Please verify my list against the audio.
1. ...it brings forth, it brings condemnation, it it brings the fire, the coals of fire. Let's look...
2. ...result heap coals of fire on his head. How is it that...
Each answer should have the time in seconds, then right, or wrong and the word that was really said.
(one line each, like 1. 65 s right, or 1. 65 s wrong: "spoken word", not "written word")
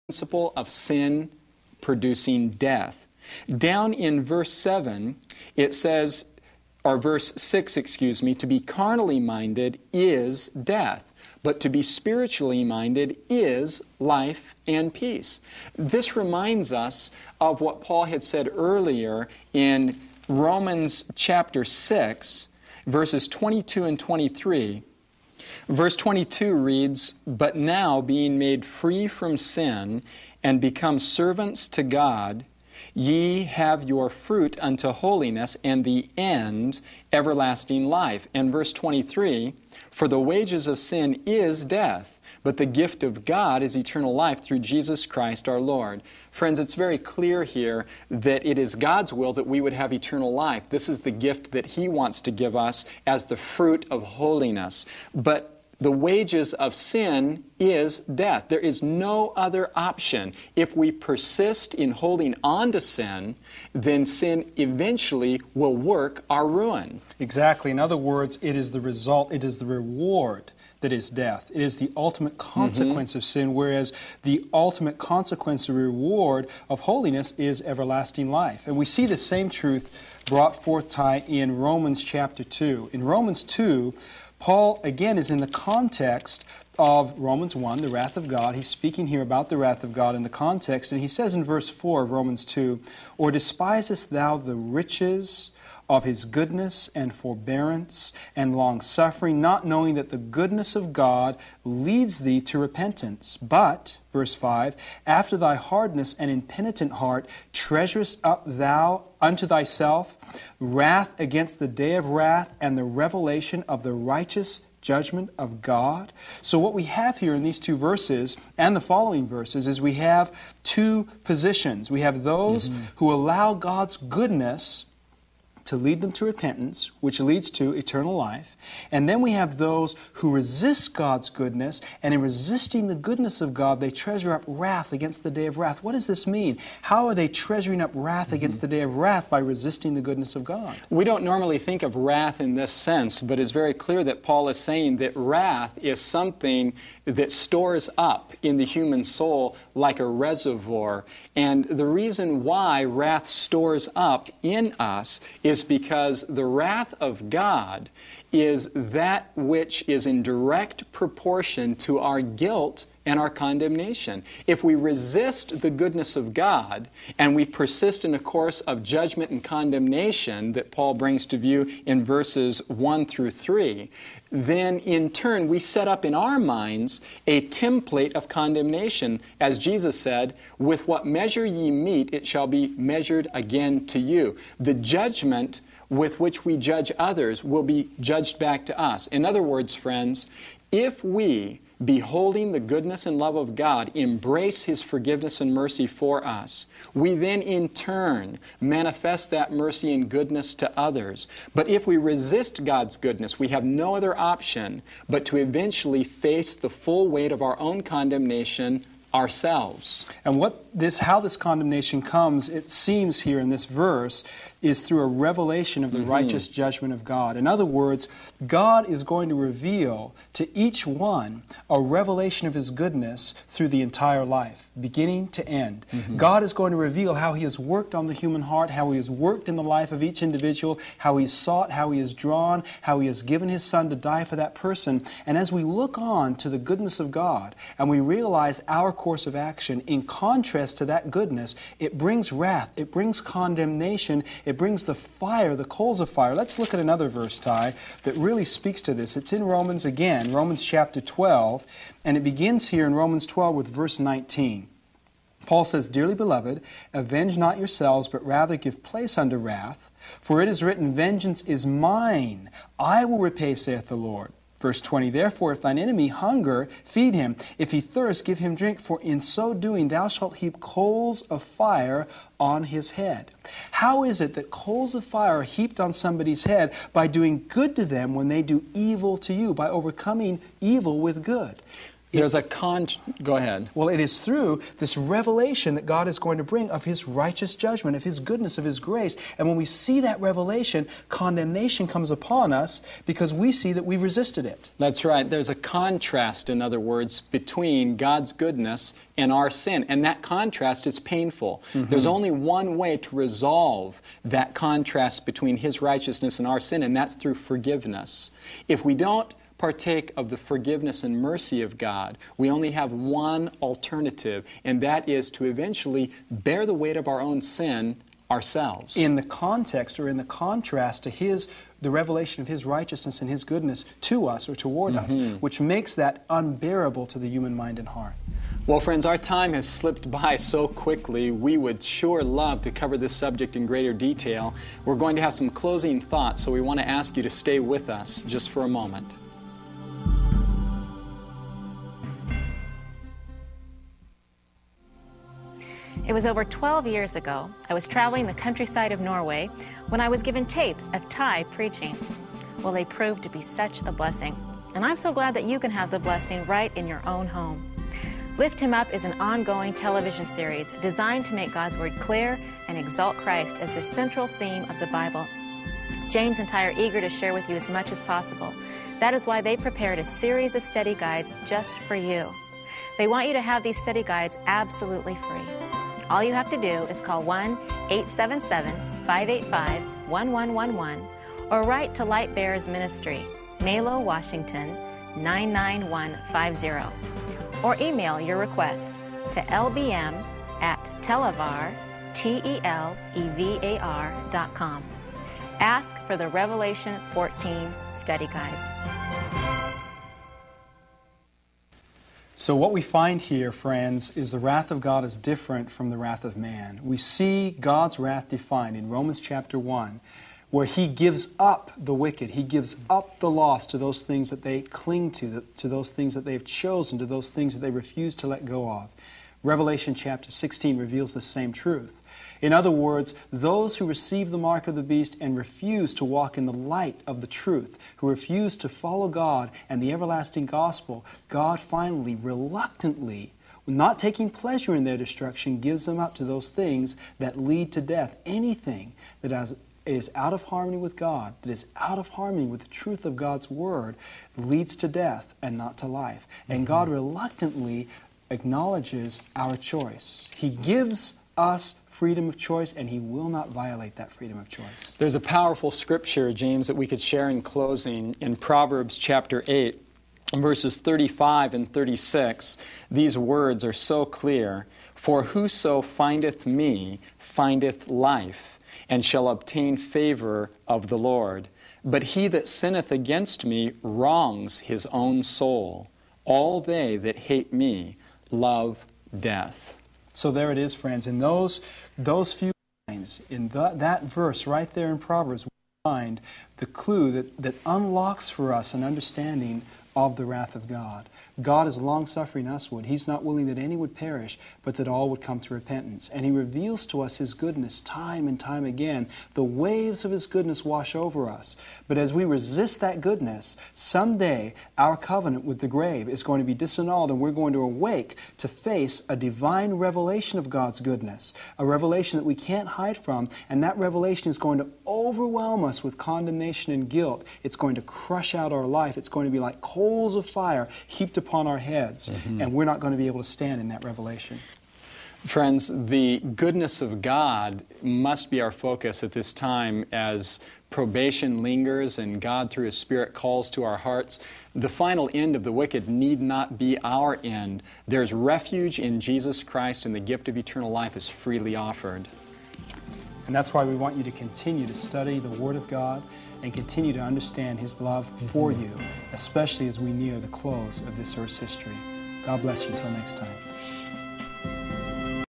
1. 241 s wrong: "wrath", not "forth"
2. 270 s wrong: "shalt", not "result".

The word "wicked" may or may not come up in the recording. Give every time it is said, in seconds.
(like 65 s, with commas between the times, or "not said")
411 s, 535 s.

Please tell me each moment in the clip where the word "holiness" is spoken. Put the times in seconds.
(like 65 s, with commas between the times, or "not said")
34 s, 54 s, 76 s.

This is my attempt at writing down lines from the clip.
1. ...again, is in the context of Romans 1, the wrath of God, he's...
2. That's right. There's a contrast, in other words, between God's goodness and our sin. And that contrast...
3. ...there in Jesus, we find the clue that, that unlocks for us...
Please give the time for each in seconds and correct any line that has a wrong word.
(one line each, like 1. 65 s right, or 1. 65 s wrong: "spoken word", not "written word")
1. 84 s right
2. 294 s right
3. 484 s wrong: "Proverbs", not "Jesus".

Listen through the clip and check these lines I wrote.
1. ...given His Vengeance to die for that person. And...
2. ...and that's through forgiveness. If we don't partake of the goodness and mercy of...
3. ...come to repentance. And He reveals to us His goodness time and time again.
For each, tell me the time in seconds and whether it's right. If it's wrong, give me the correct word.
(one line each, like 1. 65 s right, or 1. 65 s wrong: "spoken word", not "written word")
1. 233 s wrong: "Son", not "Vengeance"
2. 306 s wrong: "forgiveness", not "goodness"
3. 495 s right.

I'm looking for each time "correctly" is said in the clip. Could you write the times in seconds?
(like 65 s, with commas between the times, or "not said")
not said.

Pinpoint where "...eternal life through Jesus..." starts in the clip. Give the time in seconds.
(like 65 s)
43 s.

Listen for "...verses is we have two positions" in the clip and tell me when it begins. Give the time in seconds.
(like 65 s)
119 s.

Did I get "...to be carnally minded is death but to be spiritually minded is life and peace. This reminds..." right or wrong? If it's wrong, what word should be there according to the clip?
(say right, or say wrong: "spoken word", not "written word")
right.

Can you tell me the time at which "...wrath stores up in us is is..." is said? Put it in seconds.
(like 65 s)
152 s.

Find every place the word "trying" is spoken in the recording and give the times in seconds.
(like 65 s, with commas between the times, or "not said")
not said.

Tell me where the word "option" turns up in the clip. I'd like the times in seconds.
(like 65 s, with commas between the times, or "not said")
59 s, 204 s.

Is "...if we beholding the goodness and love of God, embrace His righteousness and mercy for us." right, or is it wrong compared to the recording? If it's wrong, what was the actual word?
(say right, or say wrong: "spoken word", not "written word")
wrong: "forgiveness", not "righteousness".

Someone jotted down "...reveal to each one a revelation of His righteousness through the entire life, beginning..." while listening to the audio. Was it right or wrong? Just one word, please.
wrong.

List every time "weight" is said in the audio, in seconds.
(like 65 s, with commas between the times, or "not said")
207 s, 316 s.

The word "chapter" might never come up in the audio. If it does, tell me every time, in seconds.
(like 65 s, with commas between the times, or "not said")
21 s, 82 s, 250 s, 409 s, 419 s, 458 s.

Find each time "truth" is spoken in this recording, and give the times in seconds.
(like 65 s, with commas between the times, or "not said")
79 s, 421 s, 427 s, 442 s.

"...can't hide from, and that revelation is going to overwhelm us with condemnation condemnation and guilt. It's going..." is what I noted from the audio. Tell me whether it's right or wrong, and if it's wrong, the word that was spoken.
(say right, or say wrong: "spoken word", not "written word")
right.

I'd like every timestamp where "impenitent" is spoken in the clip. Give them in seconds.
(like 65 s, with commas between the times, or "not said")
106 s.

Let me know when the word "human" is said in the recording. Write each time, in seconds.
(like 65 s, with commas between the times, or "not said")
148 s, 228 s, 327 s.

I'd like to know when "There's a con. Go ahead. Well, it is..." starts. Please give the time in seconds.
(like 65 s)
282 s.